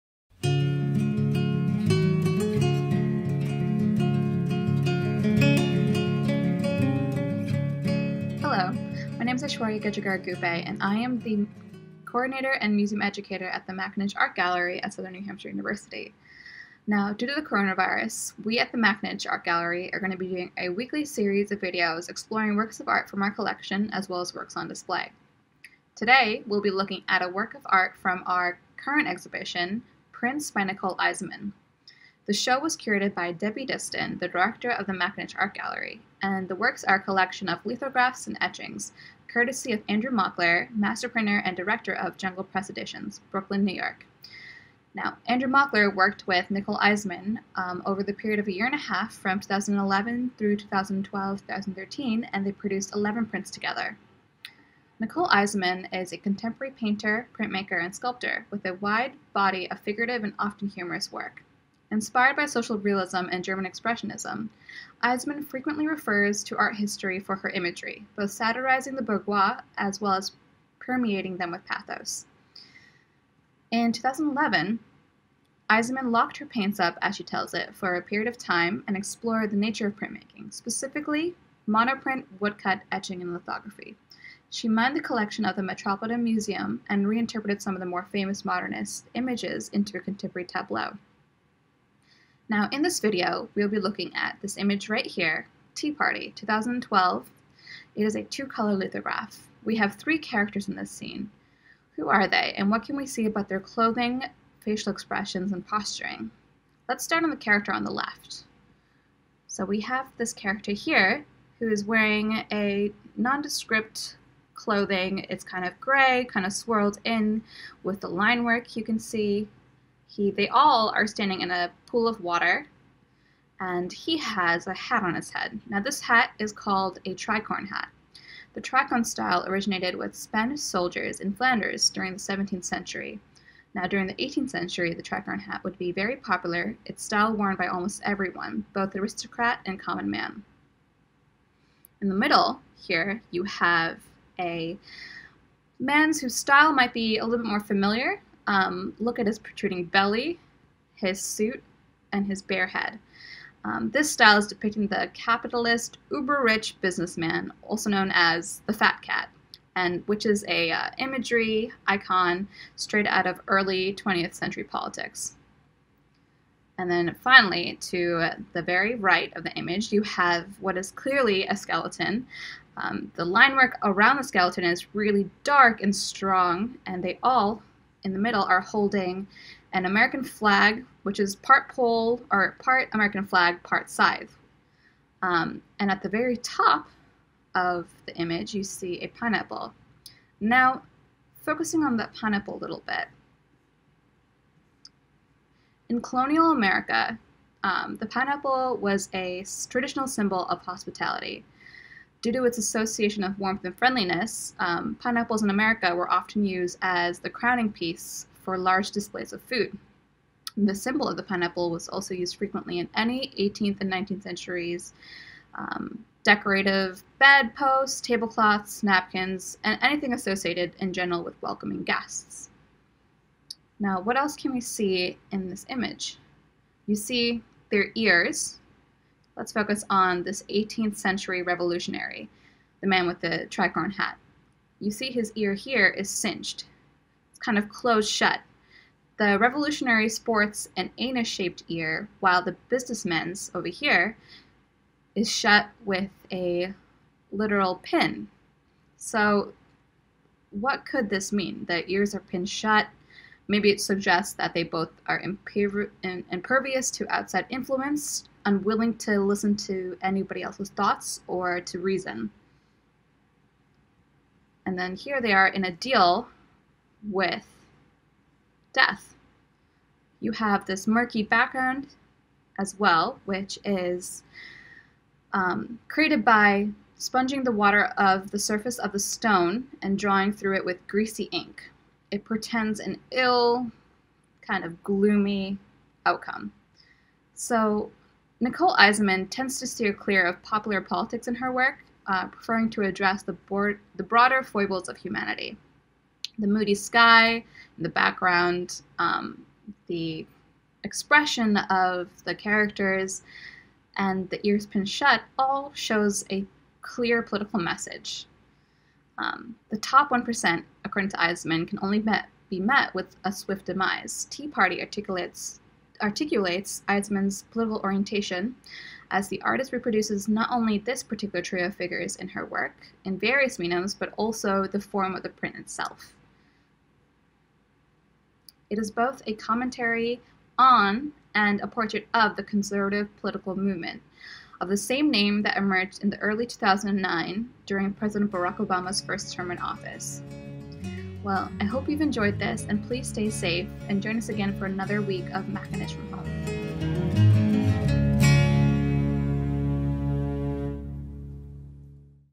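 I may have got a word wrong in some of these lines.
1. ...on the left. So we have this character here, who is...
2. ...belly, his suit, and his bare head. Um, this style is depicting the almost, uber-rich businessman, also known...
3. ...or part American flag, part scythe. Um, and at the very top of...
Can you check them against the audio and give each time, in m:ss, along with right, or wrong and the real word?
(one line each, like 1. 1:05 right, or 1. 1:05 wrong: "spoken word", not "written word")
1. 1:47 right
2. 2:29 wrong: "capitalist", not "almost"
3. 3:02 right.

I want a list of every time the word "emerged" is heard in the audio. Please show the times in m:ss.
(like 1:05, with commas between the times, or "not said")
5:35.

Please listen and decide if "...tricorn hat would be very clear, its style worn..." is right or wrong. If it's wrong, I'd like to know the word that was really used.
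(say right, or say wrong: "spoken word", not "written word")
wrong: "popular", not "clear".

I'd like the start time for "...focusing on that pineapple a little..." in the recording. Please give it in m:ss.
3:11.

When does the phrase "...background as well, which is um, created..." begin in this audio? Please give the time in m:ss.
4:31.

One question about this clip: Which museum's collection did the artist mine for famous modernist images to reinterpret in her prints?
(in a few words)
Metropolitan Museum.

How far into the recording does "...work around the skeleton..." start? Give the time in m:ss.
2:53.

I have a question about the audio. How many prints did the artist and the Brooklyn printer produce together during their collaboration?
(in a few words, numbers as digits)
11.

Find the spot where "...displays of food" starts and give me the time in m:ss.
3:28.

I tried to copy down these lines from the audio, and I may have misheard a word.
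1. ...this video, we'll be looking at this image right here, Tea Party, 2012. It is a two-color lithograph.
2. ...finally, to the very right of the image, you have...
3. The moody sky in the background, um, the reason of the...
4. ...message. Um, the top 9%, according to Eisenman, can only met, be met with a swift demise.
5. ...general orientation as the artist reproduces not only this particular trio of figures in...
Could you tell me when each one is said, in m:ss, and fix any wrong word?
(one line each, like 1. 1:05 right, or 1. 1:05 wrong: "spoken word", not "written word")
1. 1:32 right
2. 2:47 right
3. 4:56 wrong: "expression", not "reason"
4. 5:07 wrong: "1", not "9"
5. 5:17 wrong: "political", not "general".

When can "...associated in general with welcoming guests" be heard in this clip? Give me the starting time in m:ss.
3:40.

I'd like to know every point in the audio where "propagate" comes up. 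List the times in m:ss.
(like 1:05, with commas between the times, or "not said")
not said.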